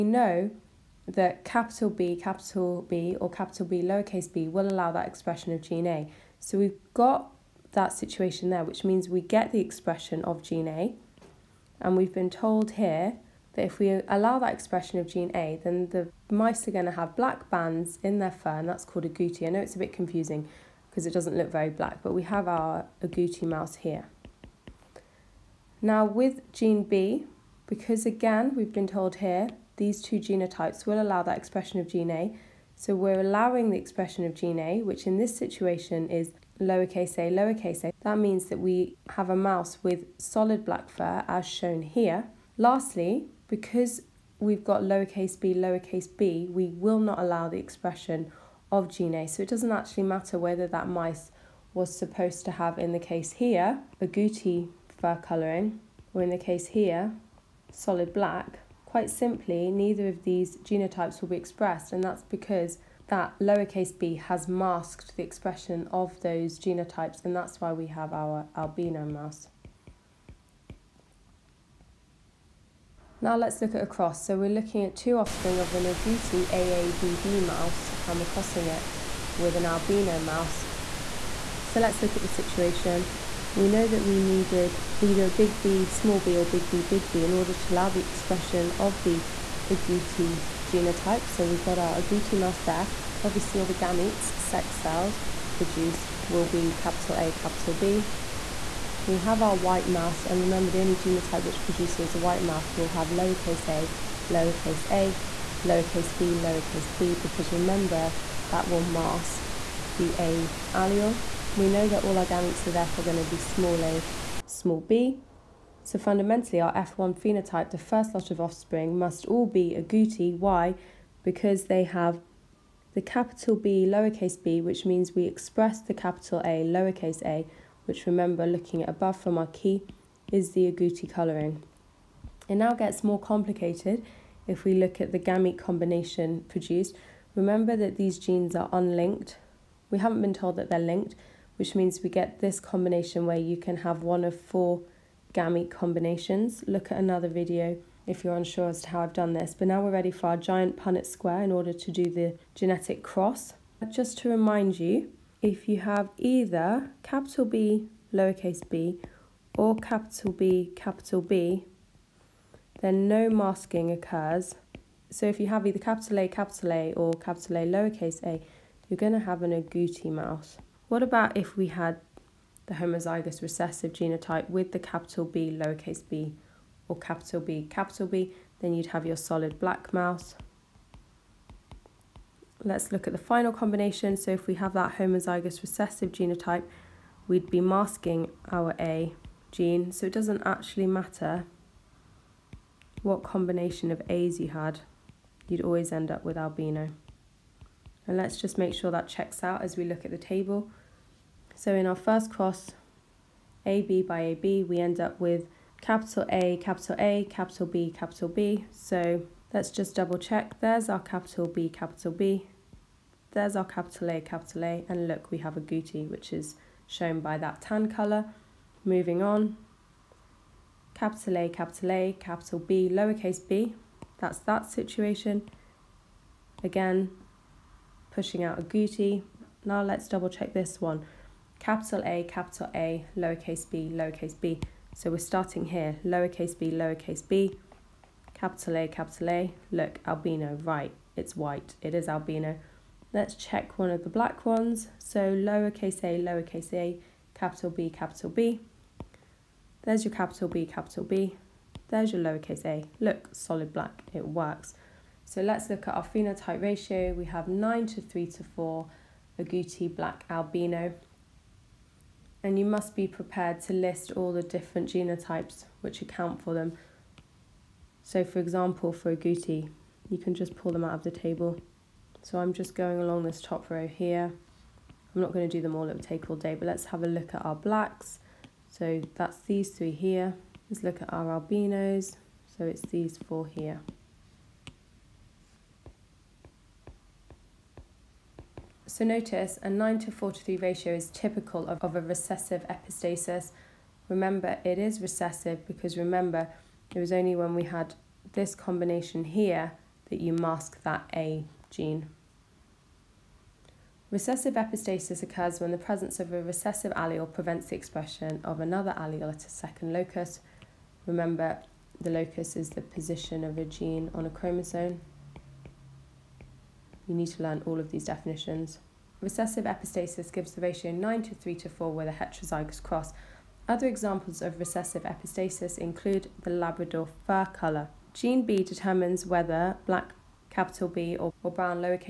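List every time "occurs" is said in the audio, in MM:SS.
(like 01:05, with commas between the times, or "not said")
02:43, 05:05.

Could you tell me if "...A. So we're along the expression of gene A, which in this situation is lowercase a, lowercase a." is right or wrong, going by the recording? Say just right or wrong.
wrong.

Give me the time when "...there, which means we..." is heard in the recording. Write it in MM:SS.
00:08.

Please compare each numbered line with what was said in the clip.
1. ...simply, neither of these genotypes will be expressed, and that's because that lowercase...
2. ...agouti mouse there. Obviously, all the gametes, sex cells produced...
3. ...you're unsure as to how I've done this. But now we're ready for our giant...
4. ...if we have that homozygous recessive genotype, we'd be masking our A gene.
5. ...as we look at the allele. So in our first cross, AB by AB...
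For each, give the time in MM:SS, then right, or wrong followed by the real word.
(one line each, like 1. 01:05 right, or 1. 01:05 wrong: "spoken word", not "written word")
1. 00:59 right
2. 01:32 right
3. 02:28 right
4. 03:04 right
5. 03:19 wrong: "table", not "allele".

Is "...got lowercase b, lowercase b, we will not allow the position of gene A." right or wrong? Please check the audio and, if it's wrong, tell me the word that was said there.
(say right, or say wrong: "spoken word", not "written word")
wrong: "expression", not "position".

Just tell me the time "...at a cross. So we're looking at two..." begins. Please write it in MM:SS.
01:13.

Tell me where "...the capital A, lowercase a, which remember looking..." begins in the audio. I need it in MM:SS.
02:05.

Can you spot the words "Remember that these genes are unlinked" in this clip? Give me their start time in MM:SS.
02:17.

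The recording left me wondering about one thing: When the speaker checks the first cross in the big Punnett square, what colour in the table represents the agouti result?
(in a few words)
Tan.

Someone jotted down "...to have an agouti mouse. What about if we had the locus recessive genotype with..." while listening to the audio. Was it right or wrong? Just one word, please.
wrong.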